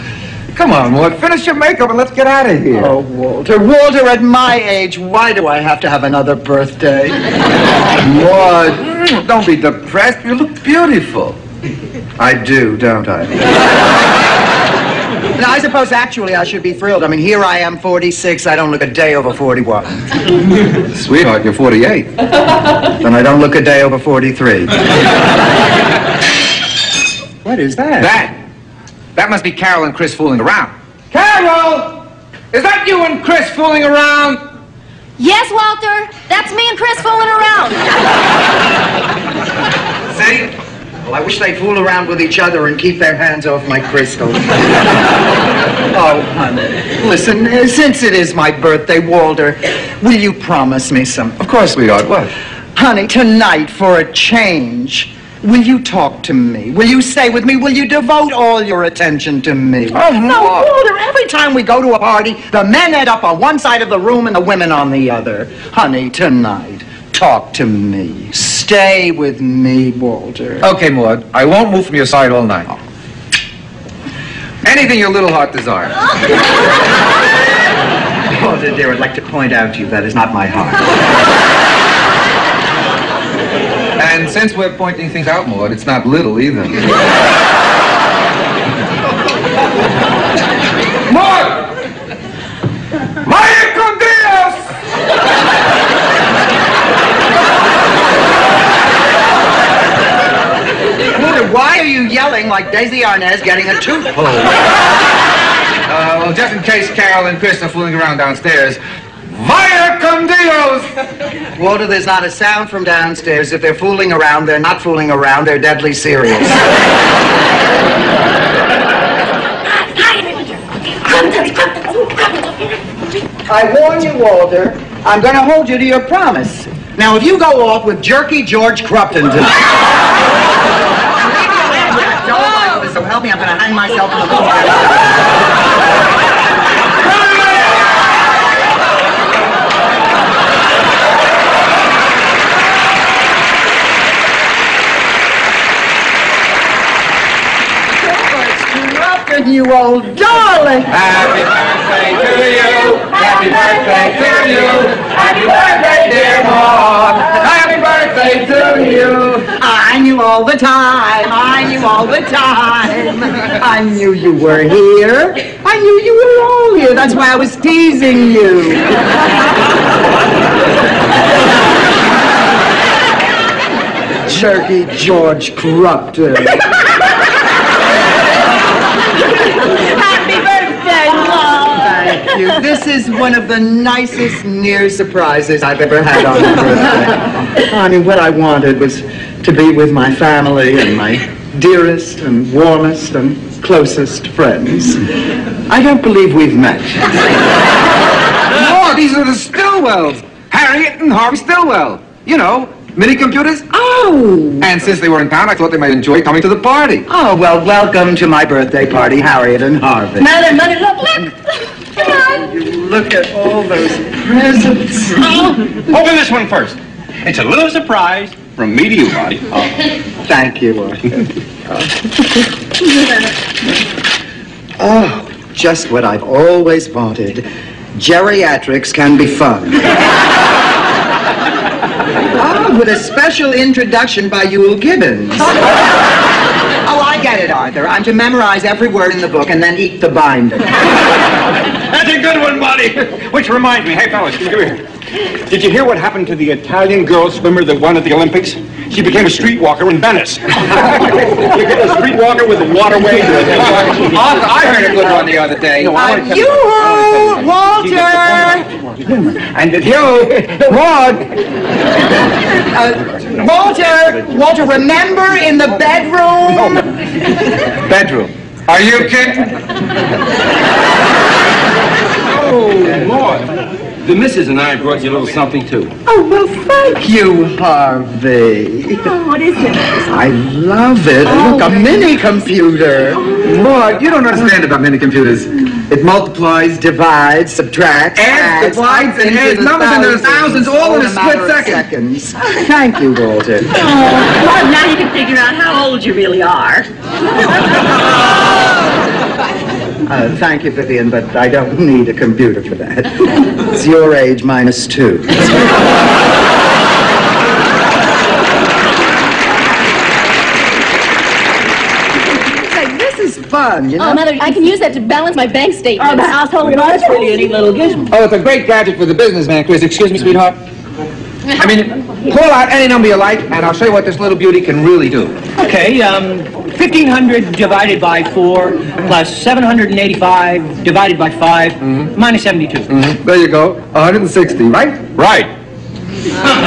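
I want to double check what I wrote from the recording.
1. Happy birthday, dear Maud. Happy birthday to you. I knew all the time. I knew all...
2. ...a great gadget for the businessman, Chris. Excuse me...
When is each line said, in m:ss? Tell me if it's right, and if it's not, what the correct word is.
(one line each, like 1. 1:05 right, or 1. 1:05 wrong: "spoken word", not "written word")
1. 2:35 right
2. 5:18 right.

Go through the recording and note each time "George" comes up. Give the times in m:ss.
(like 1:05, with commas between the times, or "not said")
2:08, 2:54.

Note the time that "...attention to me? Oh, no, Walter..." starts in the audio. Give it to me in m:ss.
0:58.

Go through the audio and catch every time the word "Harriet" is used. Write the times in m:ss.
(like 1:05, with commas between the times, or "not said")
3:20, 3:29.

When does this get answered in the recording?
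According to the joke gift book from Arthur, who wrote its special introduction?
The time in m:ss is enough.
3:54.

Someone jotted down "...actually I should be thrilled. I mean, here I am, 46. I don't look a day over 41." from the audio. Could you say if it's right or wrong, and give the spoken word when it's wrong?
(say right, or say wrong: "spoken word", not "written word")
right.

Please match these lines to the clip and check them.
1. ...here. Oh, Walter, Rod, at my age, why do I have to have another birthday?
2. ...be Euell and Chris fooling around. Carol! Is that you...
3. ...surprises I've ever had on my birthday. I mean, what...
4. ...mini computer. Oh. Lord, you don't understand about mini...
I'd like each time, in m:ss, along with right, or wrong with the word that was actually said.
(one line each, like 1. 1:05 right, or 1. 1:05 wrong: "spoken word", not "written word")
1. 0:02 wrong: "Walter", not "Rod"
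2. 0:29 wrong: "Carol", not "Euell"
3. 3:04 right
4. 4:41 right.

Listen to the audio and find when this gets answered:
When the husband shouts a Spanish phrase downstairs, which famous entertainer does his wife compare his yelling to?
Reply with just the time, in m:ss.
1:42.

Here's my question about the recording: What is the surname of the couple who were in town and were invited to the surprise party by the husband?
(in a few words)
Stillwell.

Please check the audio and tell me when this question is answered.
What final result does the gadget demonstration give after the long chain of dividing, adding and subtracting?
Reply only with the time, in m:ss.
5:33.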